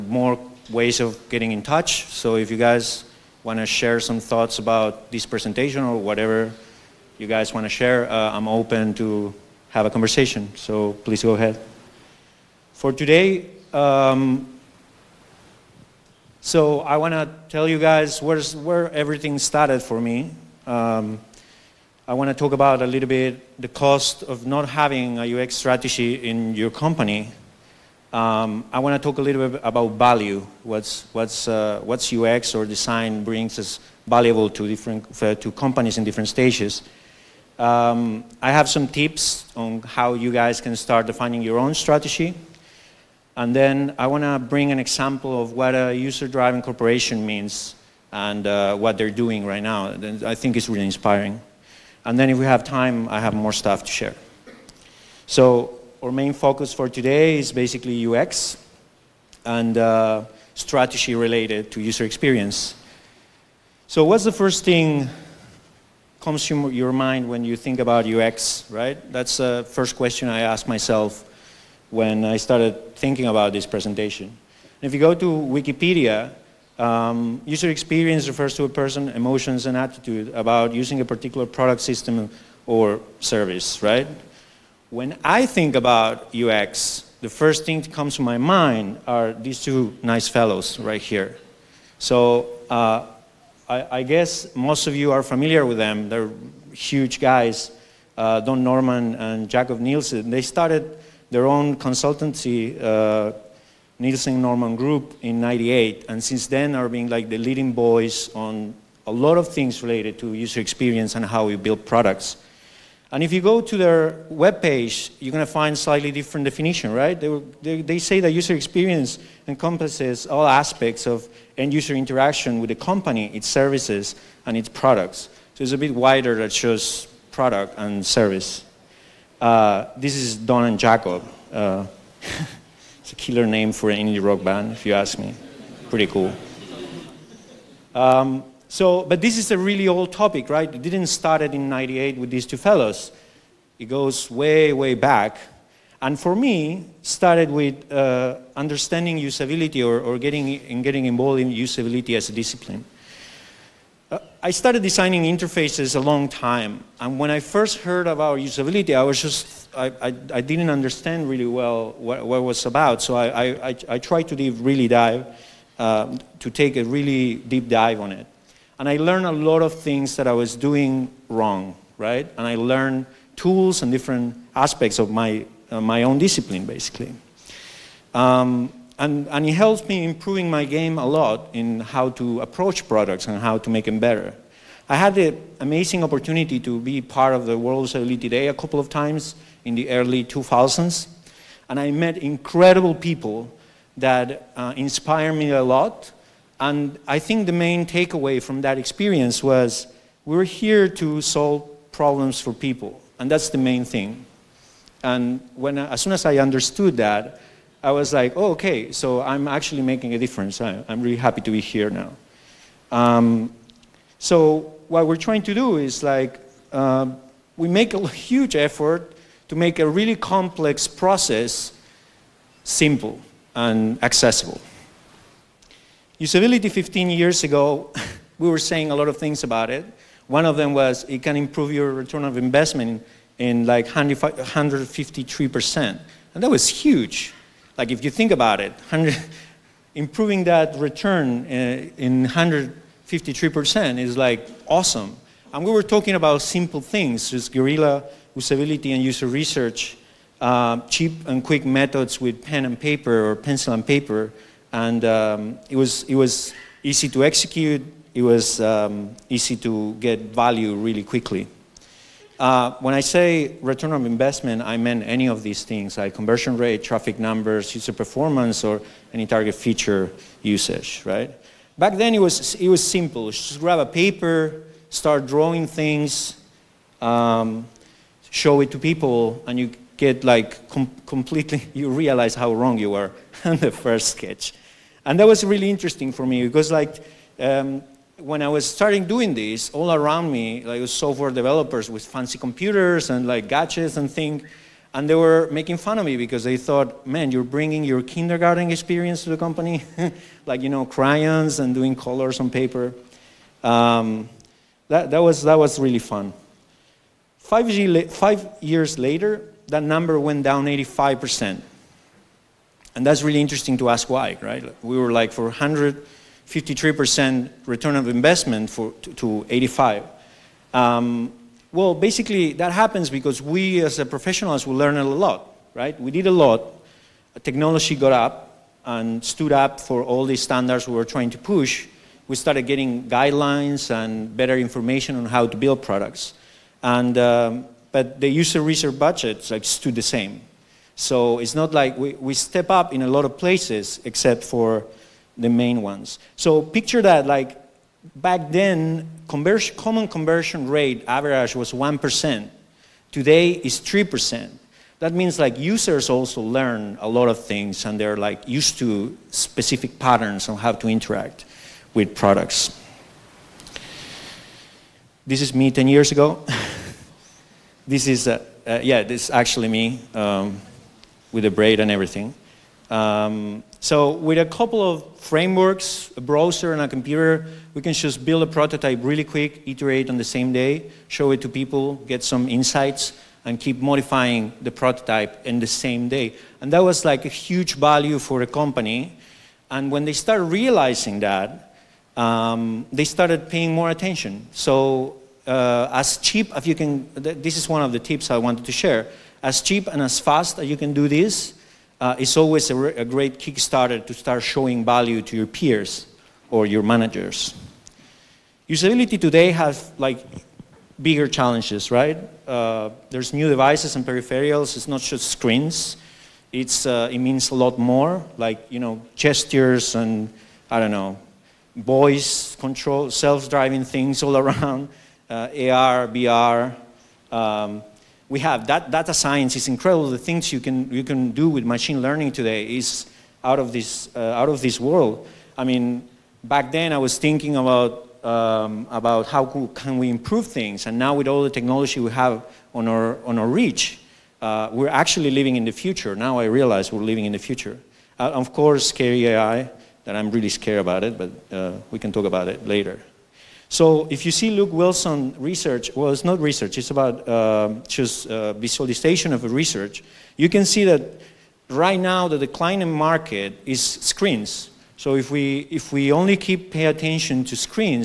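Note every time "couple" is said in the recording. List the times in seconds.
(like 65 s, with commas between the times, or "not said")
188 s, 374 s.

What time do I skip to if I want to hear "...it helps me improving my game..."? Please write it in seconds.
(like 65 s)
179 s.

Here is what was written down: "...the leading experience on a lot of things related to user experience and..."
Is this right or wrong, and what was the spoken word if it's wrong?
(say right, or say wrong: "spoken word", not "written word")
wrong: "voice", not "experience".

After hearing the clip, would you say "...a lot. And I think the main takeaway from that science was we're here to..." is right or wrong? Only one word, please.
wrong.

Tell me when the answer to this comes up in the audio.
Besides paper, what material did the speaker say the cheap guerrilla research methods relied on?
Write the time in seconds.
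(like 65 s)
253 s.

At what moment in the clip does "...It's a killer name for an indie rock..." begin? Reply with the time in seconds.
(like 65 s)
133 s.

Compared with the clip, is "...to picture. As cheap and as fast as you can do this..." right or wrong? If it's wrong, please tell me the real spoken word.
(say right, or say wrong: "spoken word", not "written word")
wrong: "share", not "picture".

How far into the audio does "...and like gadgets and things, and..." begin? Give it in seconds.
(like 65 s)
293 s.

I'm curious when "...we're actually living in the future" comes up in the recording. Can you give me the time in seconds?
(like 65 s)
444 s.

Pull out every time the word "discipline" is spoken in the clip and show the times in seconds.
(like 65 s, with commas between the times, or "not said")
152 s, 176 s.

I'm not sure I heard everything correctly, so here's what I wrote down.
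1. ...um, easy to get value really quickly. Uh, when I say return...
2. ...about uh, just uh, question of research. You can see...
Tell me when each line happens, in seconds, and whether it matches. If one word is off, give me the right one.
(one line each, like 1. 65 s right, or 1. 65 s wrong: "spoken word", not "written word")
1. 258 s right
2. 456 s wrong: "visualization", not "question".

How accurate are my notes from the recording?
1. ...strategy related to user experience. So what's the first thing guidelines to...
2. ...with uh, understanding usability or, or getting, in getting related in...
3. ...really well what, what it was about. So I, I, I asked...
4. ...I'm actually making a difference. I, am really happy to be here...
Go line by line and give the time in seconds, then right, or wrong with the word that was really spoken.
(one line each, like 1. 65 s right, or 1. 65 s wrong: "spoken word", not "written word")
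1. 60 s wrong: "comes", not "guidelines"
2. 147 s wrong: "involved", not "related"
3. 161 s wrong: "tried", not "asked"
4. 209 s right.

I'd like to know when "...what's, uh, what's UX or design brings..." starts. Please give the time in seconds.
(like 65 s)
31 s.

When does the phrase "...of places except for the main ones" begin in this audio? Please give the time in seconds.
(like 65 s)
343 s.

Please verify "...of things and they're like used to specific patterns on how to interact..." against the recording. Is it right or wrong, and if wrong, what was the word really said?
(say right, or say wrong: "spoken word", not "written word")
right.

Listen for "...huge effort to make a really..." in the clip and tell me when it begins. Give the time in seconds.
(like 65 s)
218 s.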